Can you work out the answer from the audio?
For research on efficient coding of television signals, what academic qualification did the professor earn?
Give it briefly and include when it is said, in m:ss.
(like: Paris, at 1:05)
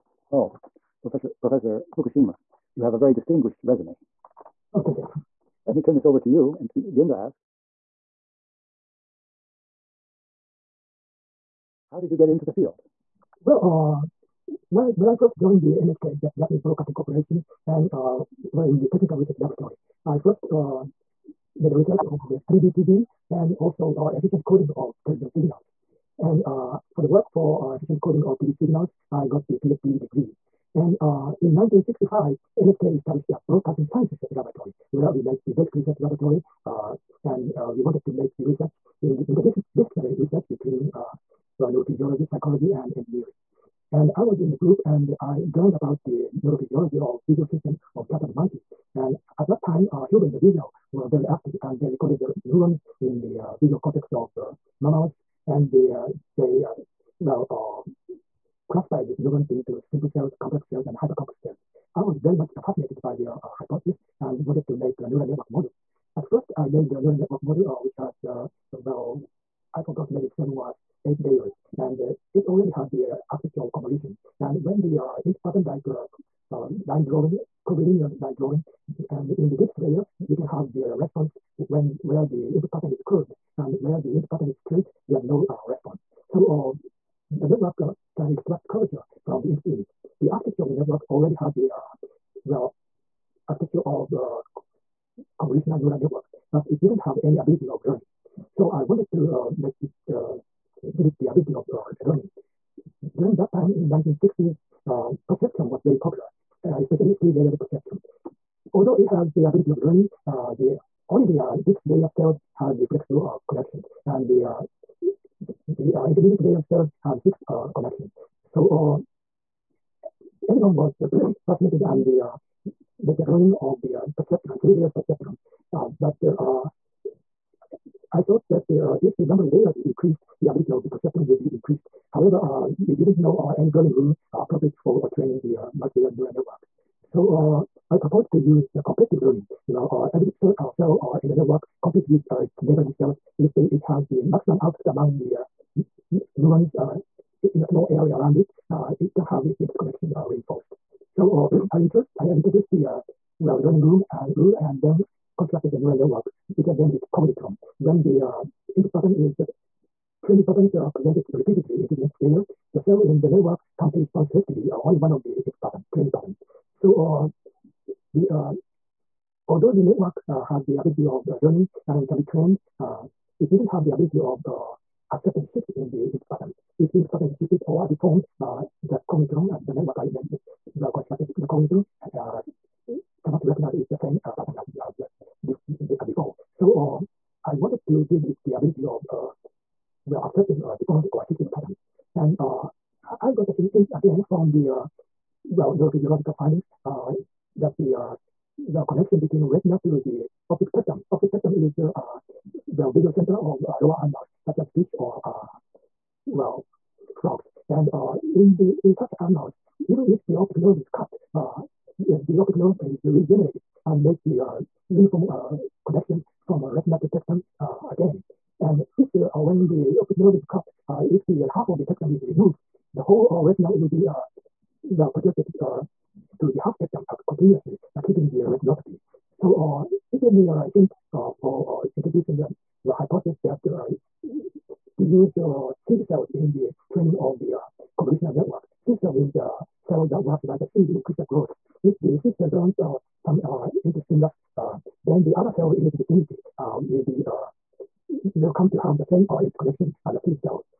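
PhD degree, at 0:29.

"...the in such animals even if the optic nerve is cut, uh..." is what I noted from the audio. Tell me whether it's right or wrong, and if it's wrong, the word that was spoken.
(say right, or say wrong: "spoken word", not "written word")
right.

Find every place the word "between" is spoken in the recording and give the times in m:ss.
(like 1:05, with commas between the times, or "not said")
0:40, 3:19.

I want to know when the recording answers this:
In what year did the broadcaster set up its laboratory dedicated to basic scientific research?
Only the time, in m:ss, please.
0:31.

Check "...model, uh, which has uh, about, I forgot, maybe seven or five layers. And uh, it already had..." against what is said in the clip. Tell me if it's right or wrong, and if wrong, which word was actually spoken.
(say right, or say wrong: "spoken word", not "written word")
wrong: "eight", not "five".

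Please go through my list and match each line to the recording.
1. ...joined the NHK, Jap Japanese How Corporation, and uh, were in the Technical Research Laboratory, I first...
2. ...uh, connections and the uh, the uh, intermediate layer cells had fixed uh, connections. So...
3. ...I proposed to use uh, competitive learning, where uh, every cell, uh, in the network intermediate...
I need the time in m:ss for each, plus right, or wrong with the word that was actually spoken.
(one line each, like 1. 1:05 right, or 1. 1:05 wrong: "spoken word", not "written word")
1. 0:15 wrong: "Broadcasting", not "How"
2. 1:53 right
3. 2:17 wrong: "compete", not "intermediate".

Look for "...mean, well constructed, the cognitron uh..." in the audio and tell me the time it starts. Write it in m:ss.
3:00.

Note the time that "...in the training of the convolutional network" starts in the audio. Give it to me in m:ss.
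3:56.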